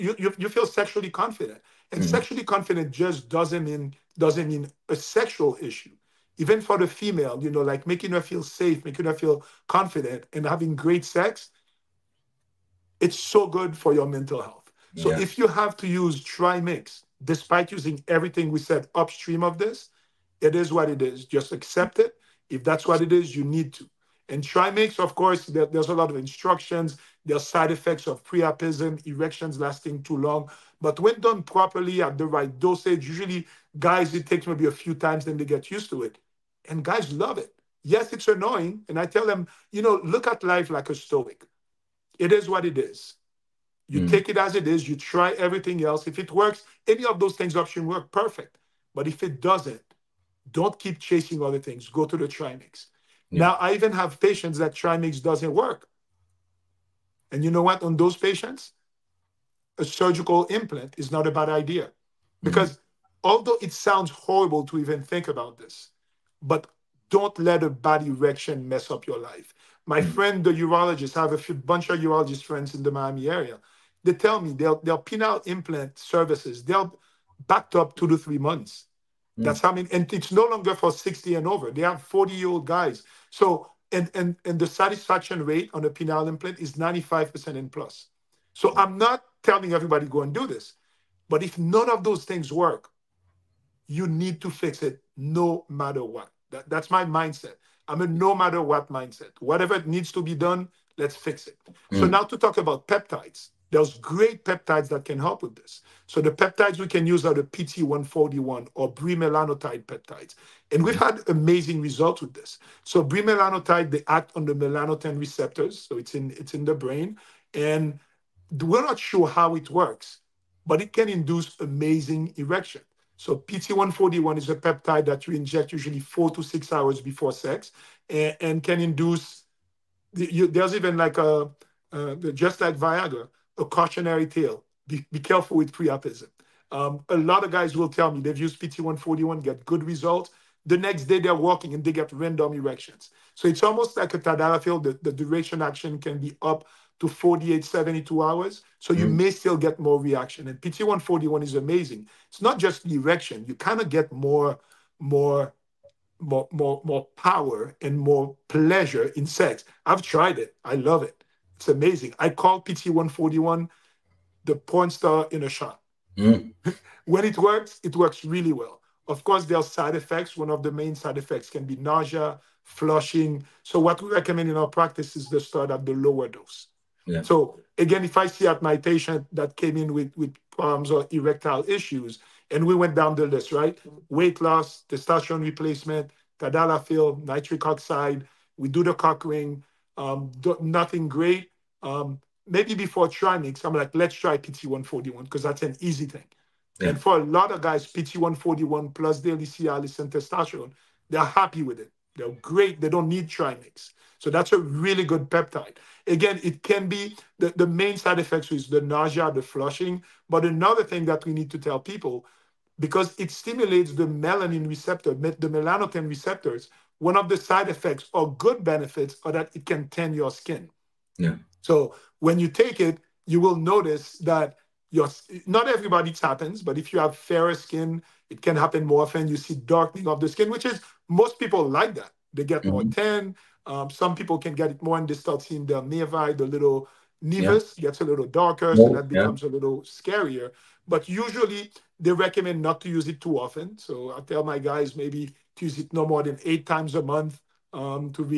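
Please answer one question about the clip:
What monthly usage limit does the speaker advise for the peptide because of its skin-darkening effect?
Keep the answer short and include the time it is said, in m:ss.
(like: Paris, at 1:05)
8 times a month, at 4:06.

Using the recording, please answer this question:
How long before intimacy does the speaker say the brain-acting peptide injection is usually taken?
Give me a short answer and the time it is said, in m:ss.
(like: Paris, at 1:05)
4 to 6 hours, at 2:05.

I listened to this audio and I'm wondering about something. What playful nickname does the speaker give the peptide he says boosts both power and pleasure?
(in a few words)
the porn star in a shot.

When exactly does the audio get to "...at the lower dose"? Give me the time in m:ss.
2:55.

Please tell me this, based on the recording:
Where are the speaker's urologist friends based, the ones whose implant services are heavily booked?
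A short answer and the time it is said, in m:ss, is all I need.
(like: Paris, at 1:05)
Miami, at 1:12.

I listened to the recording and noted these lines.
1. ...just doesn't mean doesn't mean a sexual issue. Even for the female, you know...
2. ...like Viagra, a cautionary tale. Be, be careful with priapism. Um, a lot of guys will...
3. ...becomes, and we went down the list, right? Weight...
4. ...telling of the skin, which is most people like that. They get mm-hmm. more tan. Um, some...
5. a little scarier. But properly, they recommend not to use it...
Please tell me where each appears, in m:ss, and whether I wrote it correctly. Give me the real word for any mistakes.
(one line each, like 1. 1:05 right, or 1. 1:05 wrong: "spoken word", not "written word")
1. 0:02 right
2. 2:12 right
3. 3:01 wrong: "issues", not "becomes"
4. 3:49 wrong: "darkening", not "telling"
5. 3:59 wrong: "usually", not "properly".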